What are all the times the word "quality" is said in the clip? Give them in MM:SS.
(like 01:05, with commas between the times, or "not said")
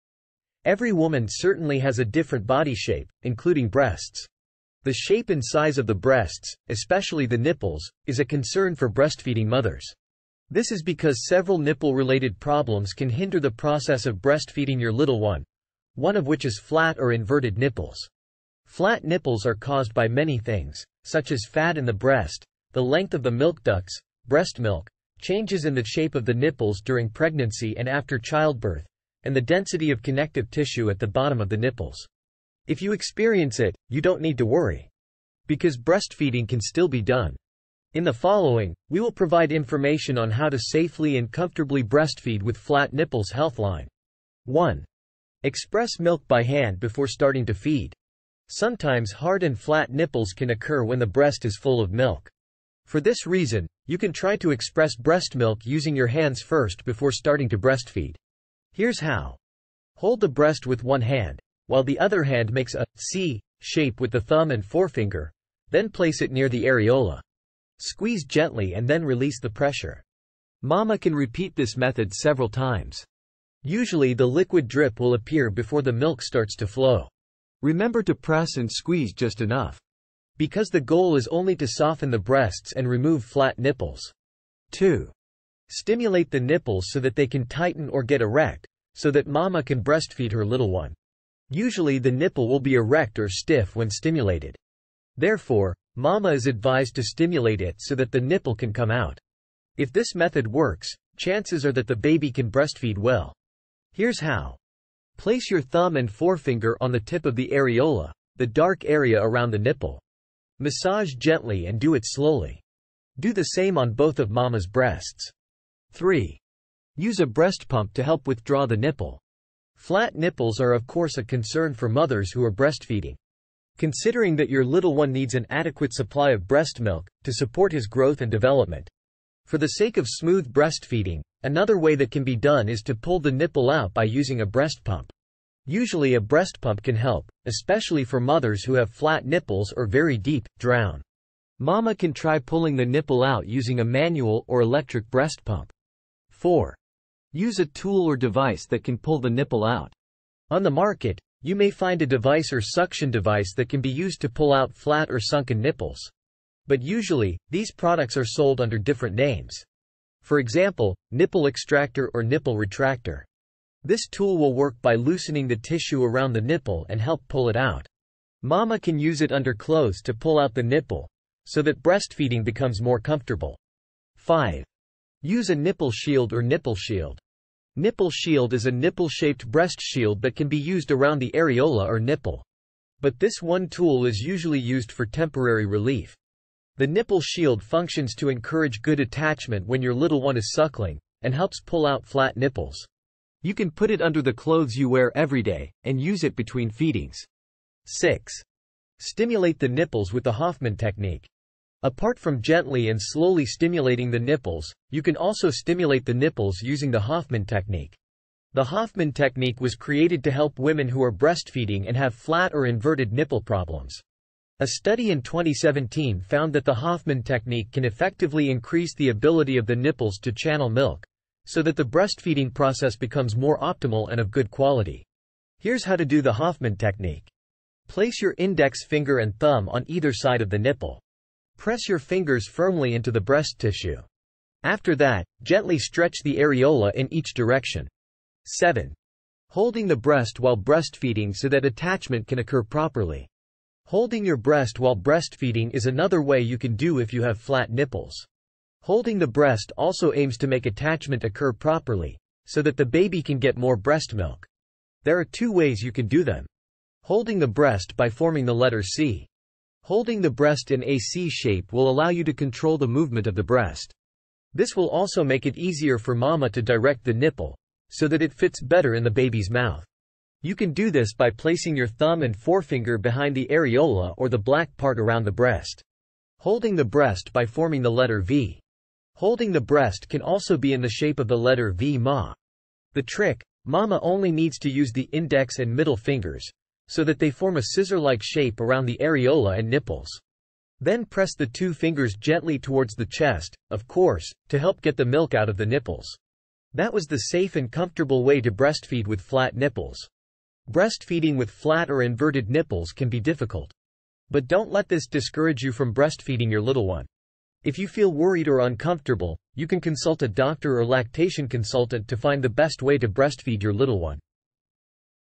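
03:44.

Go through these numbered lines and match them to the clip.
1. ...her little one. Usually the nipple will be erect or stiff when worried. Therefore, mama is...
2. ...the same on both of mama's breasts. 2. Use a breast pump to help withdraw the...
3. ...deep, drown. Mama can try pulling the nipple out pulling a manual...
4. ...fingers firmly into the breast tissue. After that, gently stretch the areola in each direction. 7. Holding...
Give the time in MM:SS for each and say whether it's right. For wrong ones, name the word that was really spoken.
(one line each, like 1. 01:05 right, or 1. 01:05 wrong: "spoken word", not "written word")
1. 01:30 wrong: "stimulated", not "worried"
2. 01:53 wrong: "3", not "2"
3. 02:20 wrong: "using", not "pulling"
4. 03:51 right.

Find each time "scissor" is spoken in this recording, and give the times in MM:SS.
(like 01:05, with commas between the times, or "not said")
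04:47.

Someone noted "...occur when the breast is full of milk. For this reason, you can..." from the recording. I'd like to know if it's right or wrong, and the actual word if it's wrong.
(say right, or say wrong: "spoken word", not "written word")
right.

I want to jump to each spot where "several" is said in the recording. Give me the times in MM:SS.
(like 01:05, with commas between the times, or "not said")
00:11, 01:12.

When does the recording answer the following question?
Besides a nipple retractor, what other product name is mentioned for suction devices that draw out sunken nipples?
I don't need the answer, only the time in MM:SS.
02:41.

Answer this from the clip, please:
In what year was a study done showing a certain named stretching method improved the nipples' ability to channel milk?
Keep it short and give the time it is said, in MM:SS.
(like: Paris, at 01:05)
2017, at 03:35.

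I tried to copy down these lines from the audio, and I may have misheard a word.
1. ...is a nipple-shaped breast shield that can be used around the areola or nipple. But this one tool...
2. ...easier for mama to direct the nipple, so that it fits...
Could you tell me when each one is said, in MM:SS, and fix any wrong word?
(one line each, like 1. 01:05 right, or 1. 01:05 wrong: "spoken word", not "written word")
1. 02:58 right
2. 04:25 right.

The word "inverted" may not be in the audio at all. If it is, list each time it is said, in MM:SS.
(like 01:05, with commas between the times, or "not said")
00:17, 03:32, 05:02.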